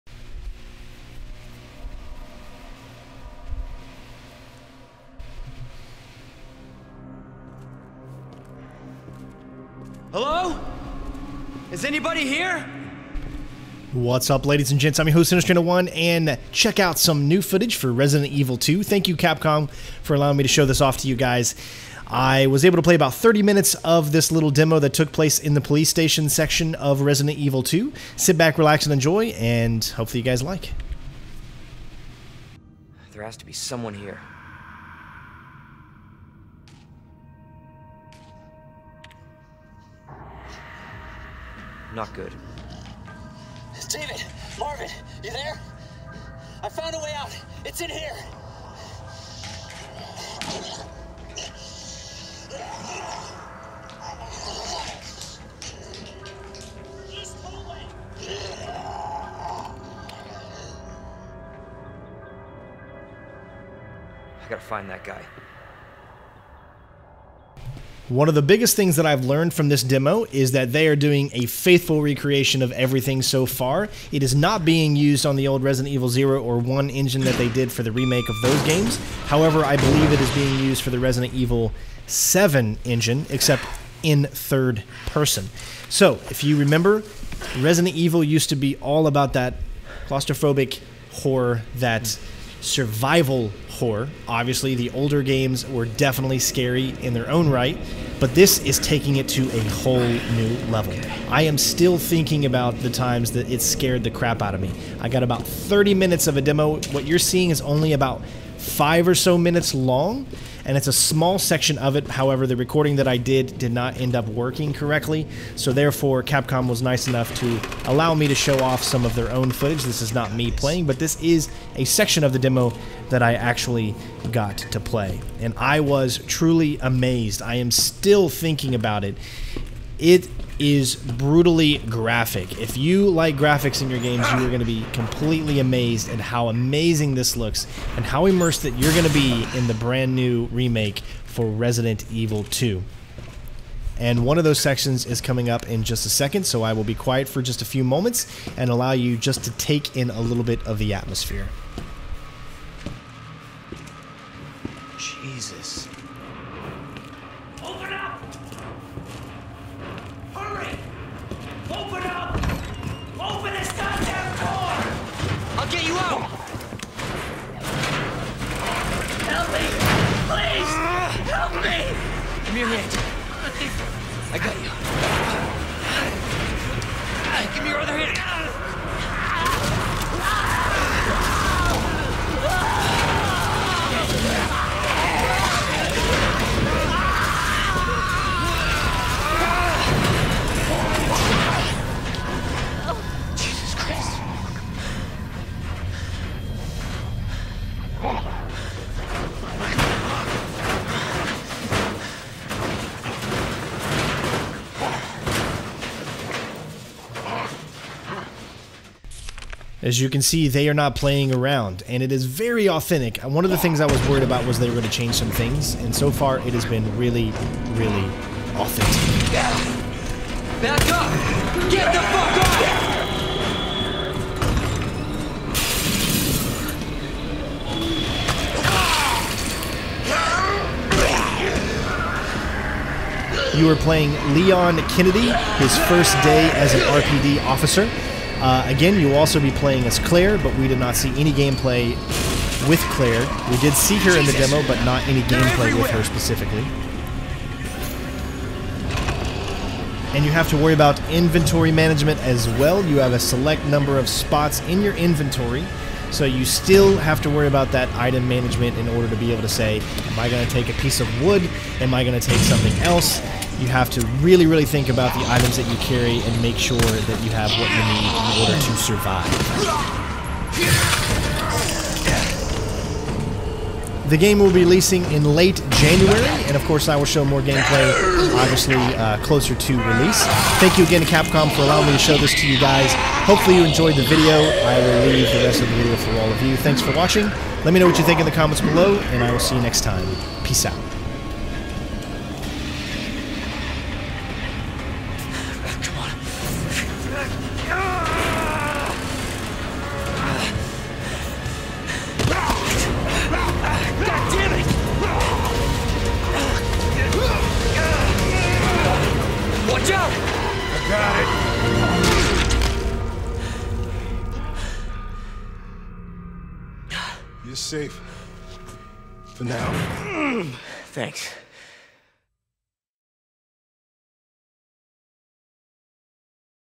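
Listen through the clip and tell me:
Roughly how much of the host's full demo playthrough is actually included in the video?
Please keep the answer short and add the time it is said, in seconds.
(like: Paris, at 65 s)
5 minutes, at 107 s.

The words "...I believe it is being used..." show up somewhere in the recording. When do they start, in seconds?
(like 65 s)
79 s.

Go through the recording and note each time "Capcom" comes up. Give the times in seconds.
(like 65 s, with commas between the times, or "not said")
19 s, 116 s, 281 s.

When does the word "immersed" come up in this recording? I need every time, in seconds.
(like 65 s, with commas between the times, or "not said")
138 s.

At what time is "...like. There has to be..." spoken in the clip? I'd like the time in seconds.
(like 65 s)
30 s.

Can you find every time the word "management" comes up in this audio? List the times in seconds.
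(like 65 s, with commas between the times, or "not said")
251 s, 258 s.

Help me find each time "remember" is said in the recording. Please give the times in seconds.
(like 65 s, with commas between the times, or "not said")
86 s.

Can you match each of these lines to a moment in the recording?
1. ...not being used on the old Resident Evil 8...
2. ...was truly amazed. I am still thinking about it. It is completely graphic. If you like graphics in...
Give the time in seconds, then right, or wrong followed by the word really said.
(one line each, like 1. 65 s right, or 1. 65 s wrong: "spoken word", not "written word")
1. 74 s wrong: "0", not "8"
2. 125 s wrong: "brutally", not "completely".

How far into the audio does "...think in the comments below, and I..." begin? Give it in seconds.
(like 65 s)
288 s.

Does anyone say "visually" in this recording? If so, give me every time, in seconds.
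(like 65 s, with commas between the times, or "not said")
not said.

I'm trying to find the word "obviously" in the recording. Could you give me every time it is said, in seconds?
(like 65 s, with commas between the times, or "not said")
94 s, 278 s.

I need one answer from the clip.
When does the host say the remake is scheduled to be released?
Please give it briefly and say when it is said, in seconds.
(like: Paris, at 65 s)
late January, at 275 s.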